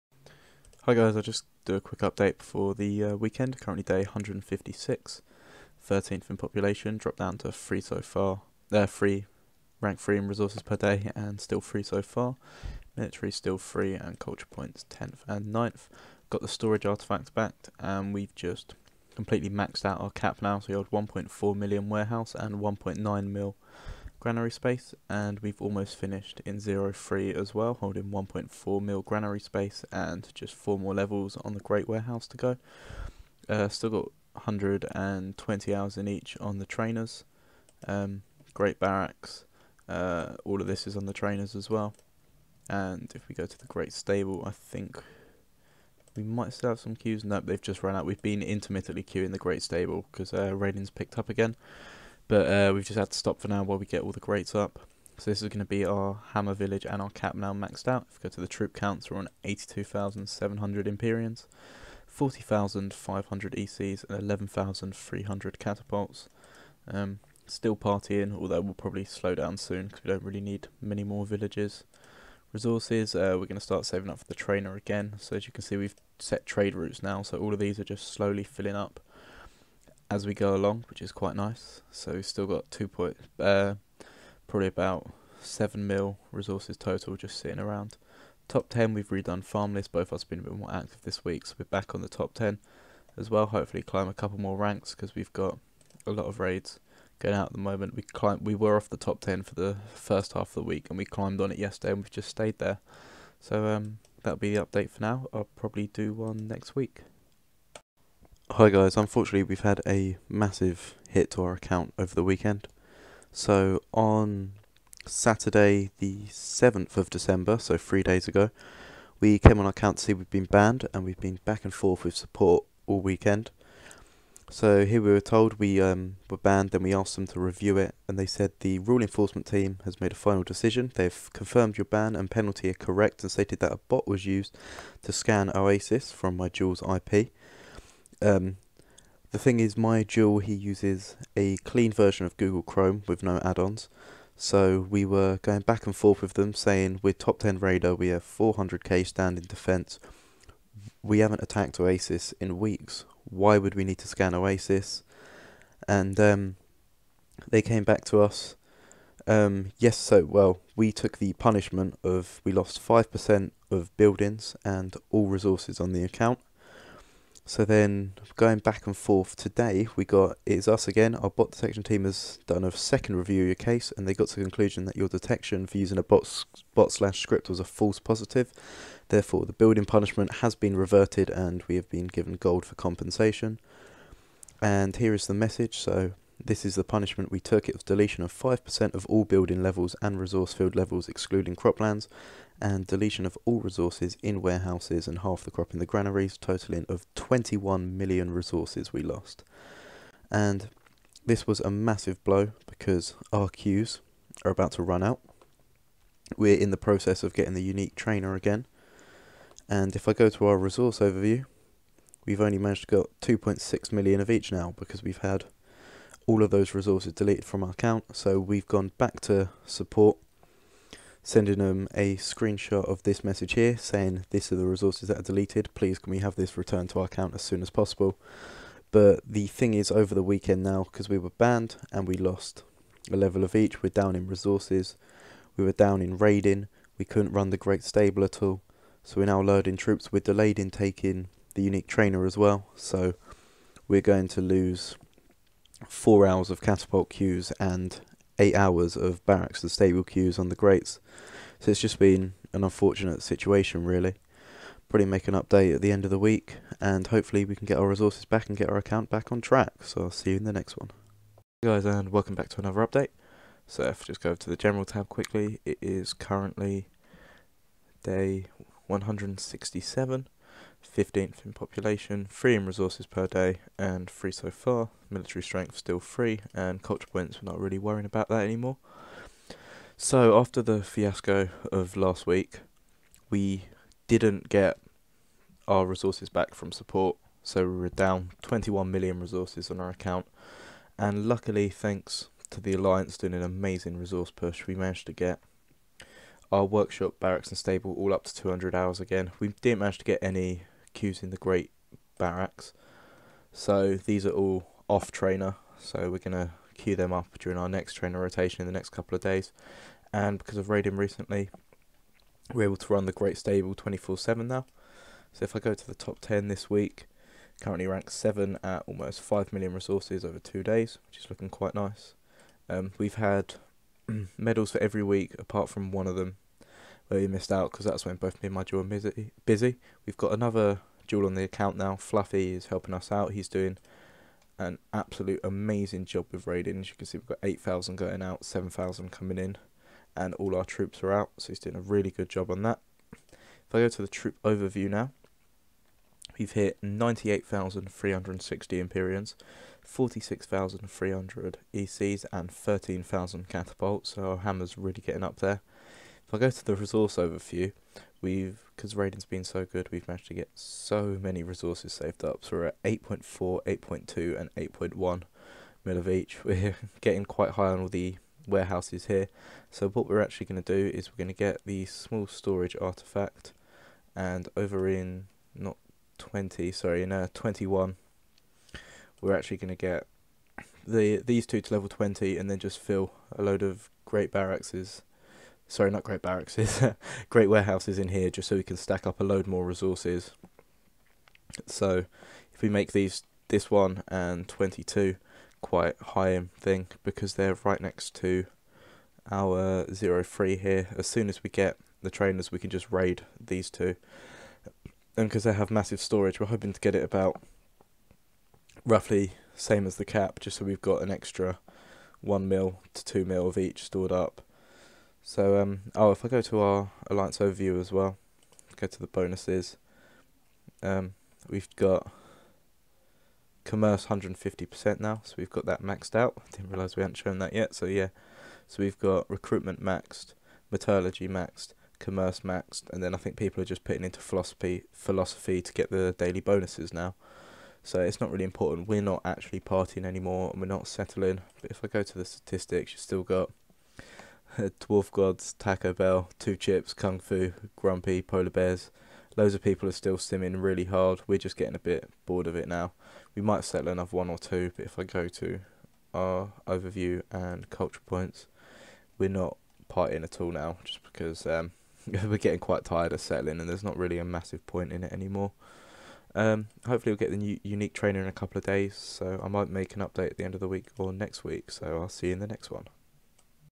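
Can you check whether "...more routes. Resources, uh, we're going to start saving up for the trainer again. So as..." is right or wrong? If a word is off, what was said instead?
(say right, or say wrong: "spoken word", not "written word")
wrong: "villages", not "routes".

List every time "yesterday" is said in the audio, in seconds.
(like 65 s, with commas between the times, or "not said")
101 s.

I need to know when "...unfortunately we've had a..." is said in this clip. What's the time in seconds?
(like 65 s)
108 s.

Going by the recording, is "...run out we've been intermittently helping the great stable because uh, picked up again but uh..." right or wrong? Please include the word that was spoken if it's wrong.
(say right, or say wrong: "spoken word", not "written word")
wrong: "queuing", not "helping".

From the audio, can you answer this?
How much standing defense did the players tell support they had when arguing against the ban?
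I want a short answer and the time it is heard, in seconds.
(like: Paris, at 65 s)
400k, at 148 s.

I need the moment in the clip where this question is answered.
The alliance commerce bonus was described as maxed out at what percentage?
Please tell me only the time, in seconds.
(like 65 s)
424 s.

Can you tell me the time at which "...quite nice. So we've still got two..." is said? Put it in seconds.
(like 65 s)
81 s.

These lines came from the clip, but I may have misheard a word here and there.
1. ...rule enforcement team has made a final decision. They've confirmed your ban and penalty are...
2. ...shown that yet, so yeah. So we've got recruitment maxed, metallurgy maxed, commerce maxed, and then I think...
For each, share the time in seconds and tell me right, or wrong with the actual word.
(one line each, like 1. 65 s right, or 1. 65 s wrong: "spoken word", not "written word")
1. 128 s right
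2. 427 s right.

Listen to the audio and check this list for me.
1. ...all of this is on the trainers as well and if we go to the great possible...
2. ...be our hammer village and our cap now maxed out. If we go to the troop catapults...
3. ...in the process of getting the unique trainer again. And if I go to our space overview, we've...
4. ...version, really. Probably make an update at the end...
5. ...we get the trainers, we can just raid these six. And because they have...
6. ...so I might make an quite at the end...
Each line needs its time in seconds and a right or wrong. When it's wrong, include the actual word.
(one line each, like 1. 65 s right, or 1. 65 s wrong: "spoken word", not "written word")
1. 40 s wrong: "stable", not "possible"
2. 55 s wrong: "counts", not "catapults"
3. 206 s wrong: "resource", not "space"
4. 253 s wrong: "situation", not "version"
5. 401 s wrong: "two", not "six"
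6. 468 s wrong: "update", not "quite".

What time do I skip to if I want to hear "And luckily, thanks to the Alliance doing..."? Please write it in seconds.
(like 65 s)
290 s.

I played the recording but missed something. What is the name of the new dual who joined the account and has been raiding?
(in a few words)
Fluffy.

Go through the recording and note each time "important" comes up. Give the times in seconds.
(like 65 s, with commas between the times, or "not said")
438 s.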